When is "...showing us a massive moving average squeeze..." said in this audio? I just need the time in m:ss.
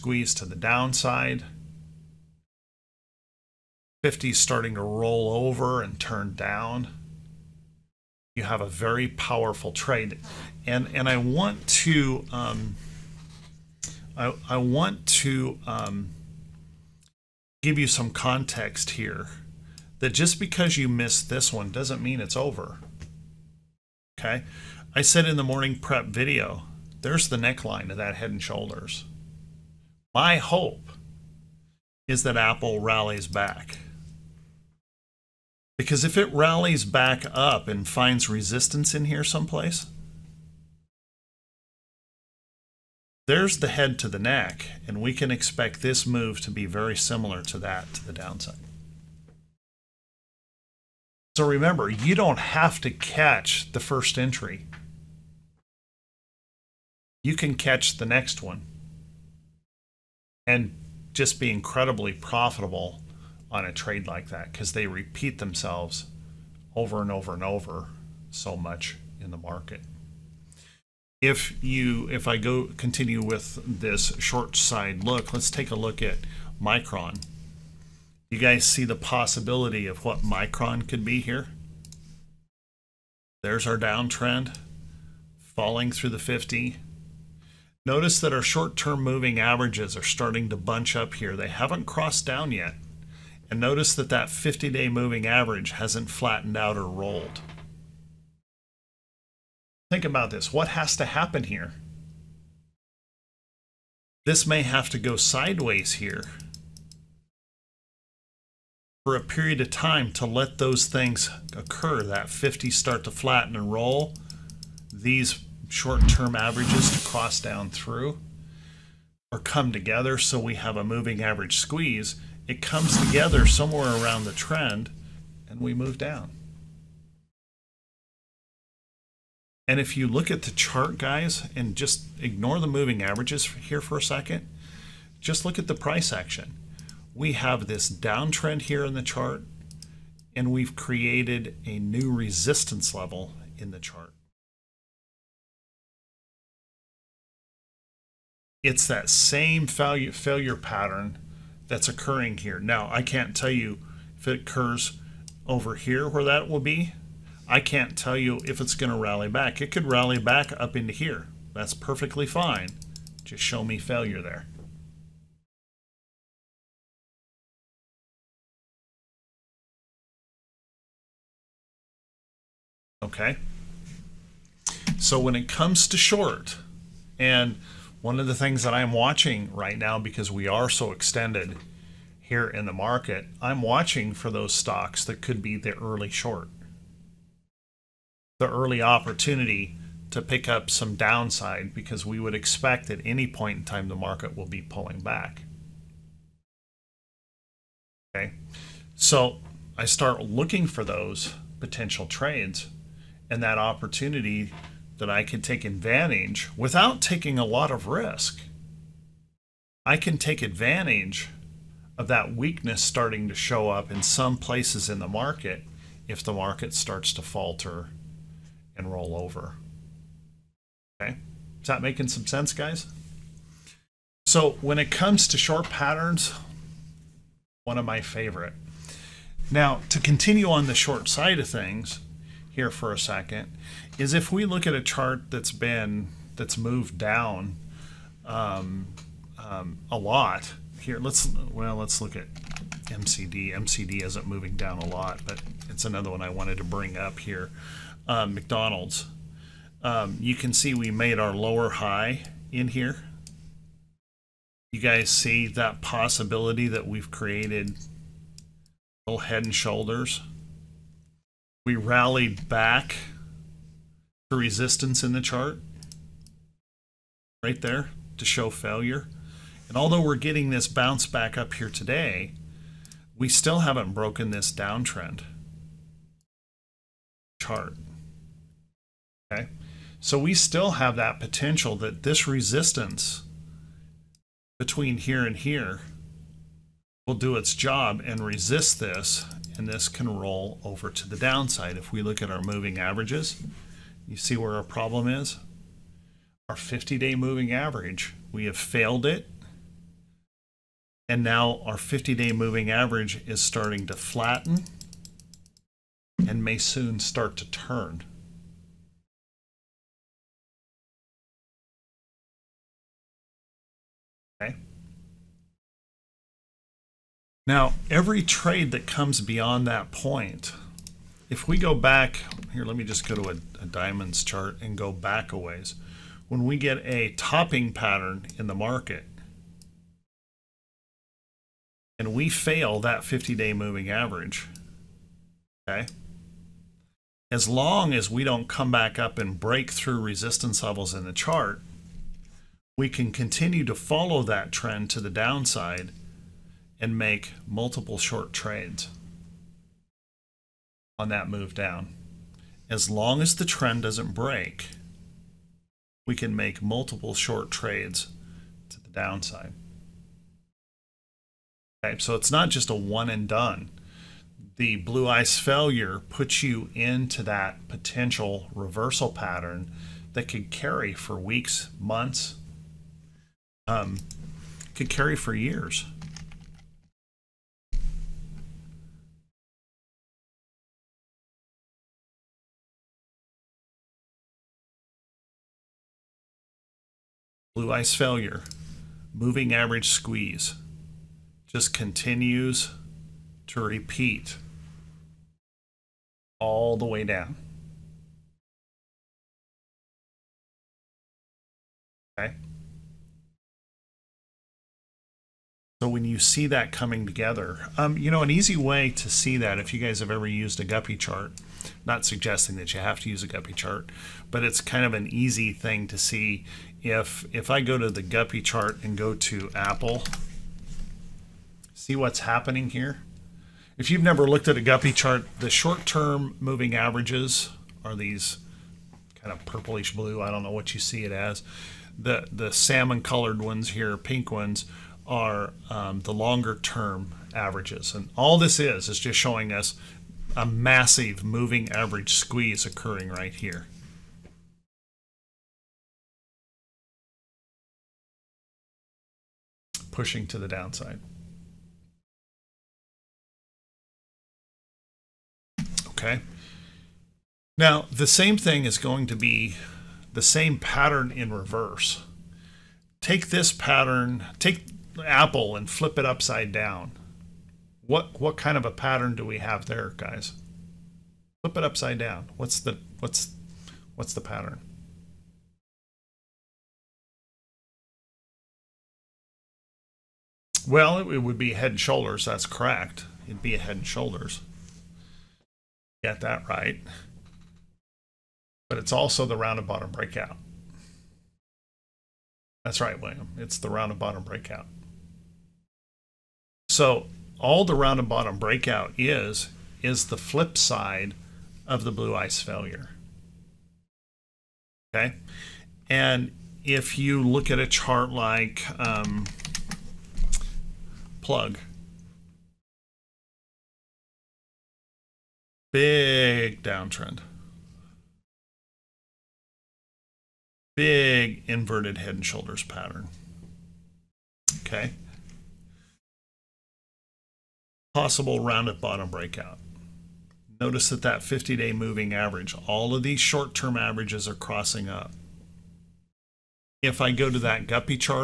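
7:19.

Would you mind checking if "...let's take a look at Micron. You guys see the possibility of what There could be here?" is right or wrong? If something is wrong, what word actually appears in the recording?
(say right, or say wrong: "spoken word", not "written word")
wrong: "Micron", not "There".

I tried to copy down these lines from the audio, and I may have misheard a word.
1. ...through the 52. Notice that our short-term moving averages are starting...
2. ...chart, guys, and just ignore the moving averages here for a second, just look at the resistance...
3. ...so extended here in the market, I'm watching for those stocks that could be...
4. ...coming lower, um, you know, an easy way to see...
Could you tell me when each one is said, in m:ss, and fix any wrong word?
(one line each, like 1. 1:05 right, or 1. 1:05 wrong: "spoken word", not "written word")
1. 1:25 wrong: "50", not "52"
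2. 2:10 wrong: "price", not "resistance"
3. 3:00 right
4. 6:46 wrong: "together", not "lower".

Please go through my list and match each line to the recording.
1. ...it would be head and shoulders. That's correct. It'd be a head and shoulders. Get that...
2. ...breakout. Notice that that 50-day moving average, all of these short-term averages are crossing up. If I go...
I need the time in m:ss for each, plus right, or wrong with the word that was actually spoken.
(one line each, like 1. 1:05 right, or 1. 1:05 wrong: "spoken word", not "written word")
1. 8:00 right
2. 8:49 right.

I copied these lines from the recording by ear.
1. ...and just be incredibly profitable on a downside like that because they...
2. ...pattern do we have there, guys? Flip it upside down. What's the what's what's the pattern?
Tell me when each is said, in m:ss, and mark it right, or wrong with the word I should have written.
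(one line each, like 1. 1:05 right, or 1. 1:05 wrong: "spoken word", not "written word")
1. 1:00 wrong: "trade", not "downside"
2. 7:48 right.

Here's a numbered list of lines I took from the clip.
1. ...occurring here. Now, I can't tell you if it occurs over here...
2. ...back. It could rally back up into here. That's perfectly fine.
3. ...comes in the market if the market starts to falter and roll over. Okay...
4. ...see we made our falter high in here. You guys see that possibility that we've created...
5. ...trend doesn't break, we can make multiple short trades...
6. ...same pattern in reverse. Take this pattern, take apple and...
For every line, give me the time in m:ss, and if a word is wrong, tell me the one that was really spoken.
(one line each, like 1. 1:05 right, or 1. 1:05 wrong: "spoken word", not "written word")
1. 2:31 right
2. 2:39 right
3. 3:34 wrong: "places", not "comes"
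4. 4:10 wrong: "lower", not "falter"
5. 5:53 right
6. 7:40 right.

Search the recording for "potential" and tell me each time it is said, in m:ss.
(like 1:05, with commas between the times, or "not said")
3:21, 4:41, 6:07.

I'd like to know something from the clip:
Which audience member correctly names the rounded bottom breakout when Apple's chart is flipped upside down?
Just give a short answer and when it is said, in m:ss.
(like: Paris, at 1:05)
William, at 8:13.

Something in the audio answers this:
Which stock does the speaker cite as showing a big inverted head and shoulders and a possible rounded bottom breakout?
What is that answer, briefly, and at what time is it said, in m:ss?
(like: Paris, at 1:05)
Plug, at 8:31.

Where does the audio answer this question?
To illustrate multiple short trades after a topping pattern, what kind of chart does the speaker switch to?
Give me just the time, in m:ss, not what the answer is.
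5:23.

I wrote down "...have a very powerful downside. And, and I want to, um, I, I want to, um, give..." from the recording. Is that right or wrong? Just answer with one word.
wrong.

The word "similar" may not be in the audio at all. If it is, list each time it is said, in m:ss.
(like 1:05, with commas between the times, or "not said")
0:46.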